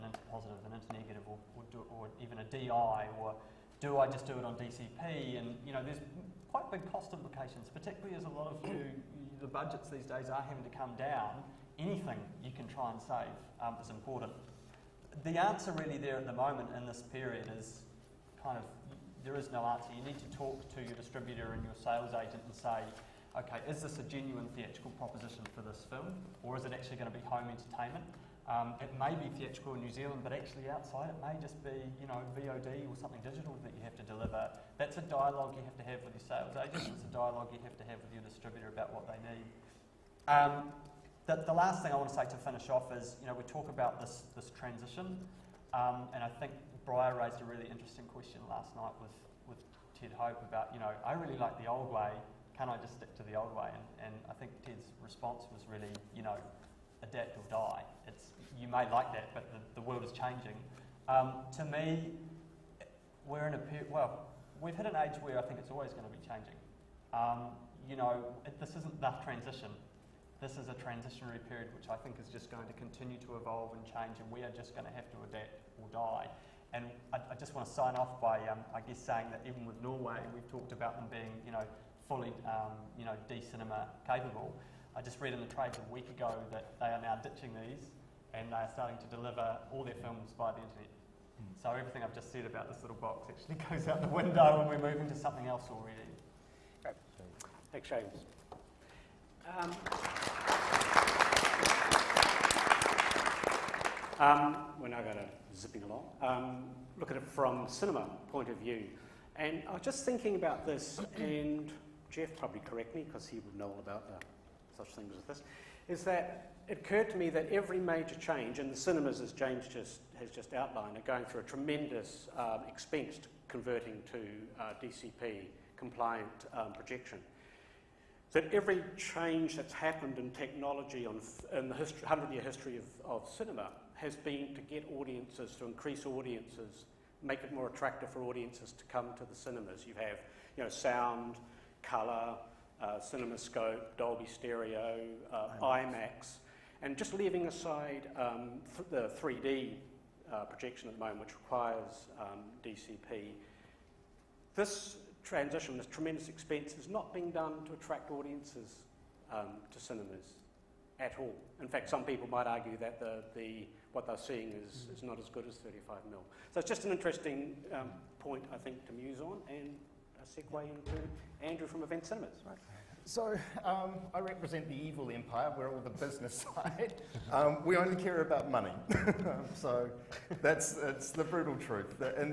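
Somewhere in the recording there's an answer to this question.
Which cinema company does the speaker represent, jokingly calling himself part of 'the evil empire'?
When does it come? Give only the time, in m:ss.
2:51.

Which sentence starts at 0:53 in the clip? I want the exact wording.
And, and I think Ted's response was really, you know, adapt or die.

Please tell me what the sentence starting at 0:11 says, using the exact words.
Anything you can try and save um, is important.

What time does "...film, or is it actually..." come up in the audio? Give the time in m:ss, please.
0:25.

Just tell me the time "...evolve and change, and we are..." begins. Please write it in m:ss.
1:13.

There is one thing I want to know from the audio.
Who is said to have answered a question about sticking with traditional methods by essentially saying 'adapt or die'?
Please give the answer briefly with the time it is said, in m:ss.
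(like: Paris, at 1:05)
Ted Hope, at 0:49.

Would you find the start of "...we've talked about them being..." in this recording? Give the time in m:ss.
1:20.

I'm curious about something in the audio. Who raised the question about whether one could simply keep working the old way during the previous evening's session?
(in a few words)
Briar.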